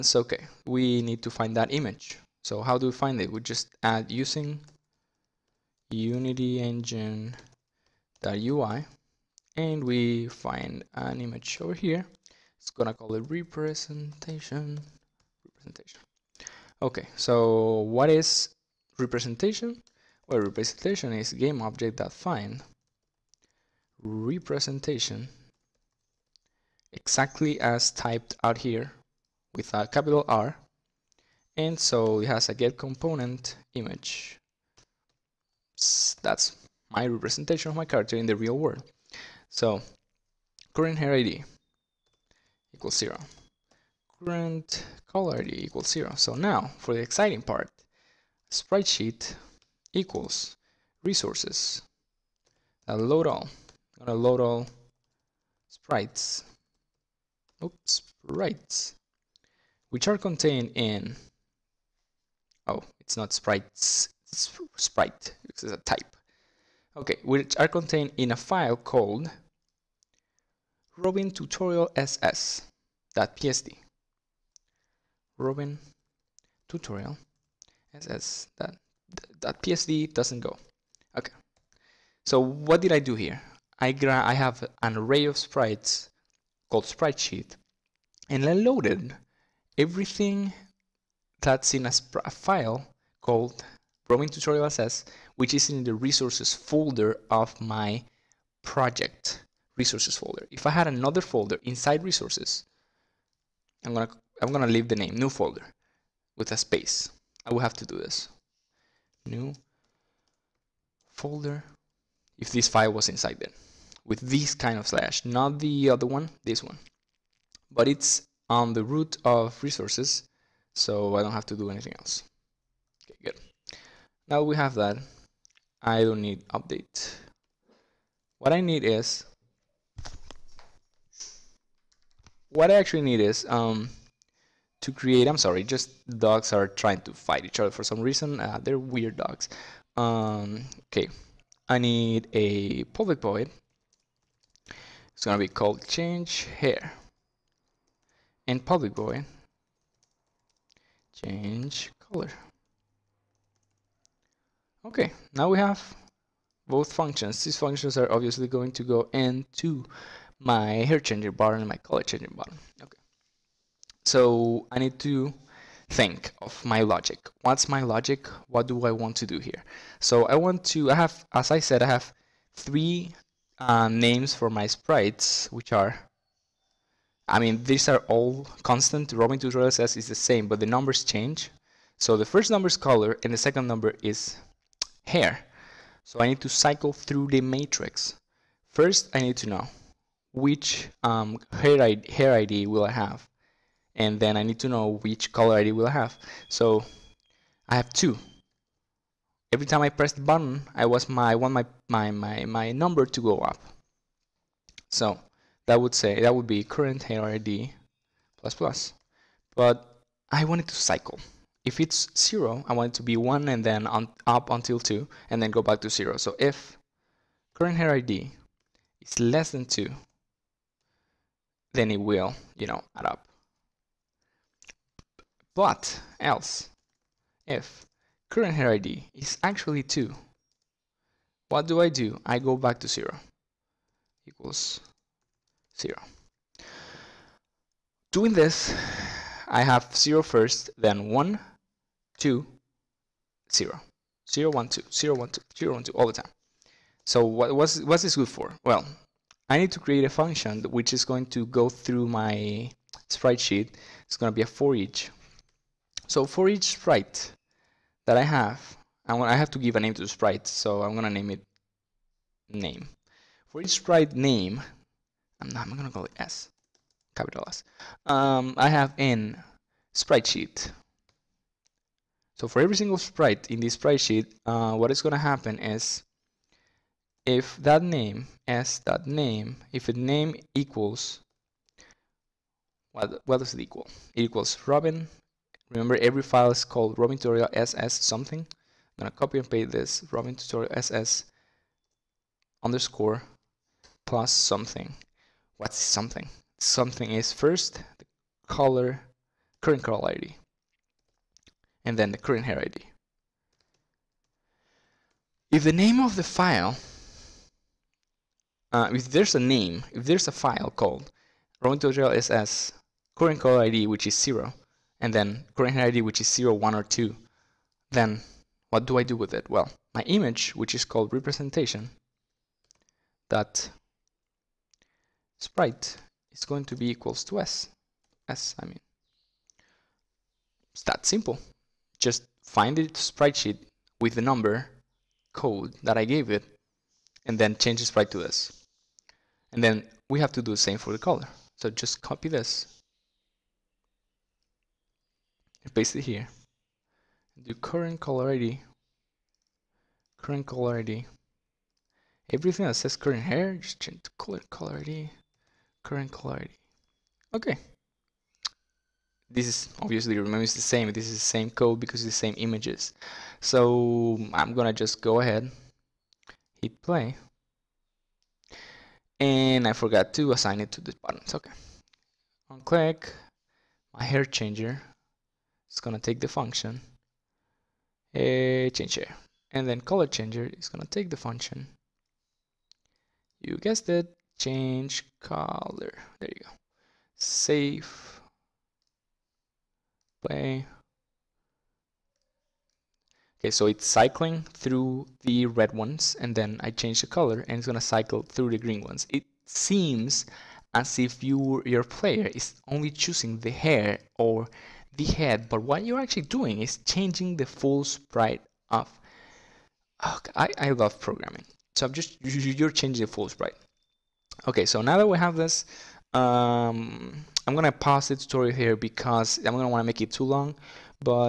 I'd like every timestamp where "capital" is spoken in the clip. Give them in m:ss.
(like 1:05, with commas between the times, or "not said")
0:29, 4:27.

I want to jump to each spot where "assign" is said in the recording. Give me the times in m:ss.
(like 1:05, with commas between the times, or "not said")
6:10.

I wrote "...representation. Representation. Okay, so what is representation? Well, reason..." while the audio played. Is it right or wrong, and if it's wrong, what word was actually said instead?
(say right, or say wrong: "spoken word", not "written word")
wrong: "representation", not "reason".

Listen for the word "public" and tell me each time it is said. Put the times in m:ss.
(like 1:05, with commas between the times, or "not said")
2:22, 2:28.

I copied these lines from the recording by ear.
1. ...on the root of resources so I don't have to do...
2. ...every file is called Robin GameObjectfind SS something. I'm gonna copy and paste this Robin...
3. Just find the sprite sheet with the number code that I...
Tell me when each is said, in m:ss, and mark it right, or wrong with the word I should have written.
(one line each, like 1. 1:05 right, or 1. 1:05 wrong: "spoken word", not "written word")
1. 1:58 right
2. 4:46 wrong: "Tutorial", not "GameObjectfind"
3. 5:31 right.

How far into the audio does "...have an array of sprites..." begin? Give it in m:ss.
1:24.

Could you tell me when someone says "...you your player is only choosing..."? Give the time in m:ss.
6:41.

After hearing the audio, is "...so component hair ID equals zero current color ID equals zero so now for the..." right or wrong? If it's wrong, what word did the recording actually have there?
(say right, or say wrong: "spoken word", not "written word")
wrong: "current", not "component".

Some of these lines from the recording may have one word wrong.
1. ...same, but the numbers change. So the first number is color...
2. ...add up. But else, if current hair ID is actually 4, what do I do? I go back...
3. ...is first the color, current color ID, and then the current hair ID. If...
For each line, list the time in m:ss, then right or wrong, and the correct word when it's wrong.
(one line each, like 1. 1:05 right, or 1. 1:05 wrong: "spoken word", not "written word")
1. 3:00 right
2. 3:42 wrong: "2", not "4"
3. 4:57 right.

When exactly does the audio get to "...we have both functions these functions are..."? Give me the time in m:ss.
2:35.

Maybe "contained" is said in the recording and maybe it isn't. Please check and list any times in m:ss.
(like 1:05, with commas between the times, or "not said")
1:00, 1:07.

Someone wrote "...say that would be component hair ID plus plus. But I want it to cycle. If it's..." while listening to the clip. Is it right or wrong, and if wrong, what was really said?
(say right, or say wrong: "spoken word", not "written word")
wrong: "current", not "component".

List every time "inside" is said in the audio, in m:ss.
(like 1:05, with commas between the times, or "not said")
1:41, 1:53.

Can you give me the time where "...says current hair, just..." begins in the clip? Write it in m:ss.
5:52.